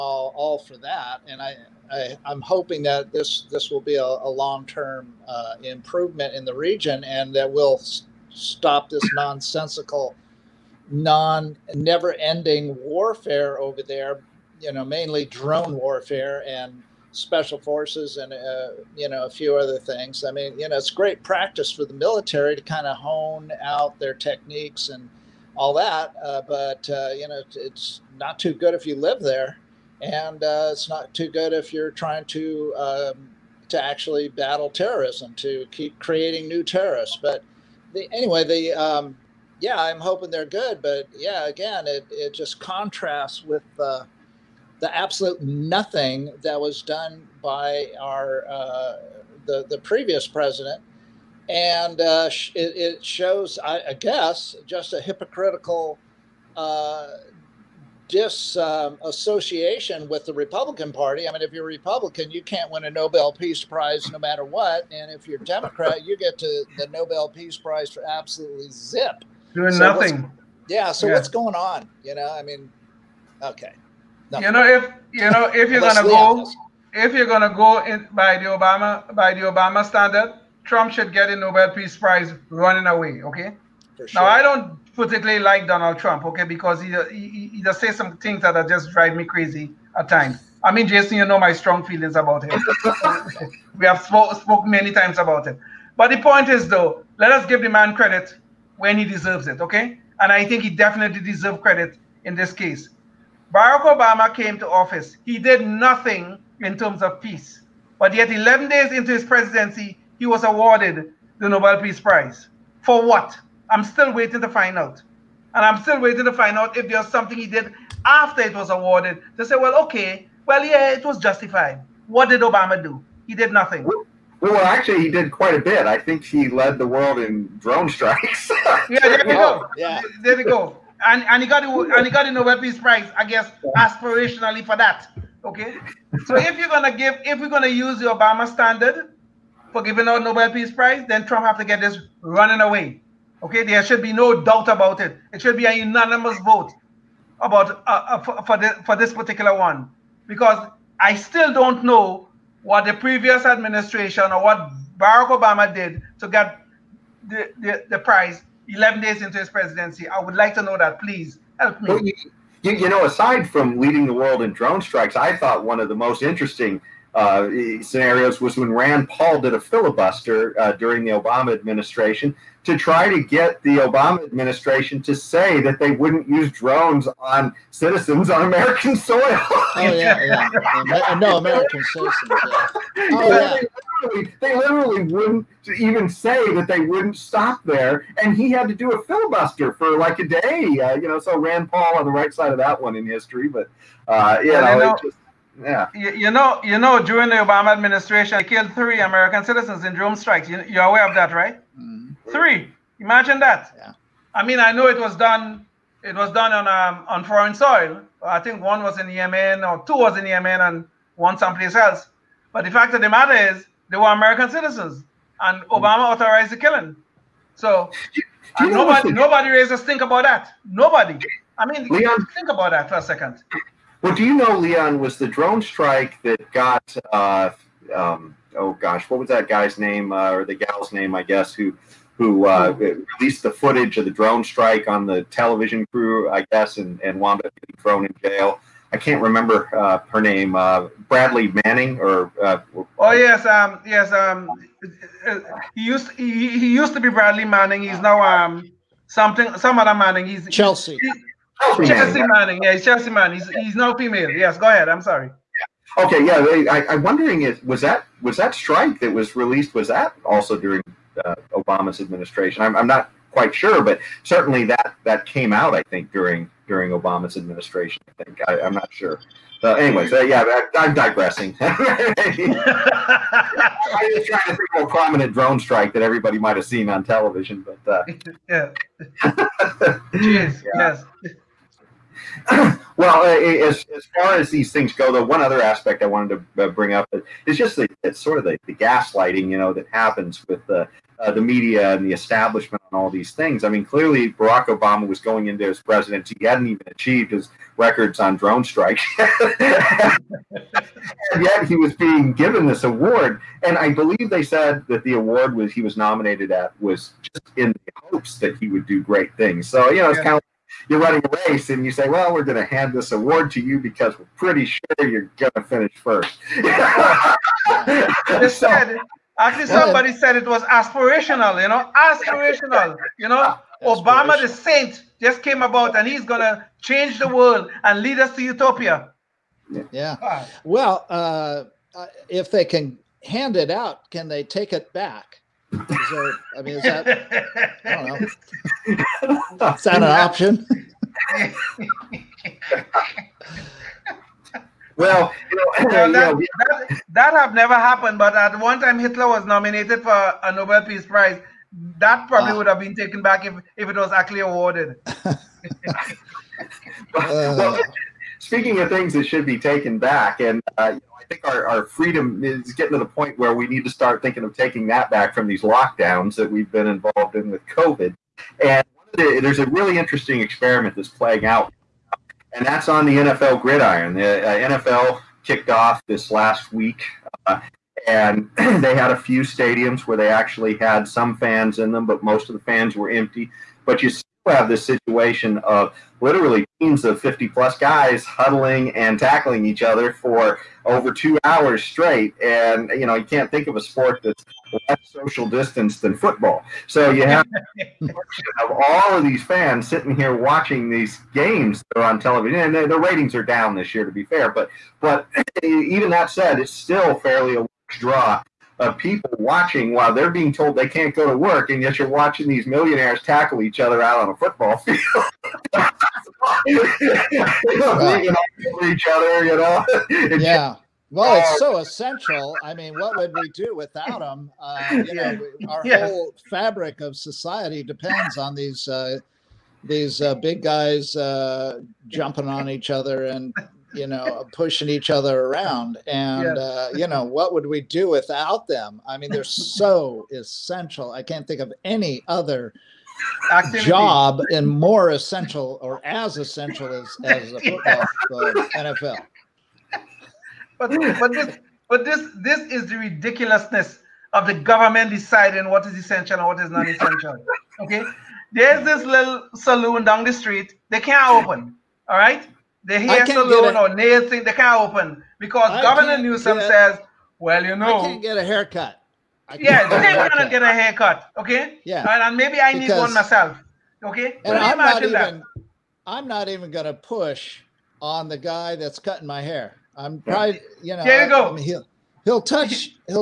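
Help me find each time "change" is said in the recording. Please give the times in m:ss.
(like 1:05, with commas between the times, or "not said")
5:26.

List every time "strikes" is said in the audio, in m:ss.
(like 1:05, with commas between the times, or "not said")
2:07, 2:44, 3:20, 3:45, 3:54, 4:18, 4:35, 4:58.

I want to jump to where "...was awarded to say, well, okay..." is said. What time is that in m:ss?
1:58.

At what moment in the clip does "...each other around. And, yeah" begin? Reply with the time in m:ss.
7:14.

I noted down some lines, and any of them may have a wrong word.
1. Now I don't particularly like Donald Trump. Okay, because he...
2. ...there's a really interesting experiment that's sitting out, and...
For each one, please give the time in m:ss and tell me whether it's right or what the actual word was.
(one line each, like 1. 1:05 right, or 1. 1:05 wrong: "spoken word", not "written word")
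1. 1:24 right
2. 6:09 wrong: "playing", not "sitting".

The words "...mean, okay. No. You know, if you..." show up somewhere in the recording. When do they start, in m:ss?
1:12.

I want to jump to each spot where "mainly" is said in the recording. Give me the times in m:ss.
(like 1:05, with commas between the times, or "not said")
0:14.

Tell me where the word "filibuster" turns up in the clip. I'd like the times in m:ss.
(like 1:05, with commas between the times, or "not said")
2:49, 3:09.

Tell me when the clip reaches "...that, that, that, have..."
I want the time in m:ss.
5:45.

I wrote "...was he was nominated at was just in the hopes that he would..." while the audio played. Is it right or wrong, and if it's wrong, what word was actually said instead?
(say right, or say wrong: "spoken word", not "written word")
right.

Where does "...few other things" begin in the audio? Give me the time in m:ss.
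0:19.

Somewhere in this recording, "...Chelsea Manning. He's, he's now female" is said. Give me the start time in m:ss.
4:12.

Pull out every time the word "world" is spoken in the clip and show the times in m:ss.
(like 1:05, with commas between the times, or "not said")
2:06, 2:44, 5:27.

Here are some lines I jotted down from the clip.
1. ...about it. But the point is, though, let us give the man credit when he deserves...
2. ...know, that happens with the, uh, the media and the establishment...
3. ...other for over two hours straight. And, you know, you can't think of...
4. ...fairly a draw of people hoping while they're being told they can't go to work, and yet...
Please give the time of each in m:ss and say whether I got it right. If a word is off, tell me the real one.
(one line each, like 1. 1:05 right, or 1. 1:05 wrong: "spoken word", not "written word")
1. 1:35 right
2. 4:49 right
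3. 6:29 right
4. 6:47 wrong: "watching", not "hoping".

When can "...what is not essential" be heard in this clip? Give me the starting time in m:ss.
7:36.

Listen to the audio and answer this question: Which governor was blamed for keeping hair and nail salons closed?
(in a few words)
Governor Newsom.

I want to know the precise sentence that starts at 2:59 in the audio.
oh yeah, yeah, uh, no American citizens.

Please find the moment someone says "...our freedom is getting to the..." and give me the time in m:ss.
6:01.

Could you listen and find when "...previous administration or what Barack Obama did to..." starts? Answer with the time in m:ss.
2:32.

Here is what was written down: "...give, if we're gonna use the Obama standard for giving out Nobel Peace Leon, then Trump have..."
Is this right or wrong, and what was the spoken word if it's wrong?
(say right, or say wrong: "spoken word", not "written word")
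wrong: "Prize", not "Leon".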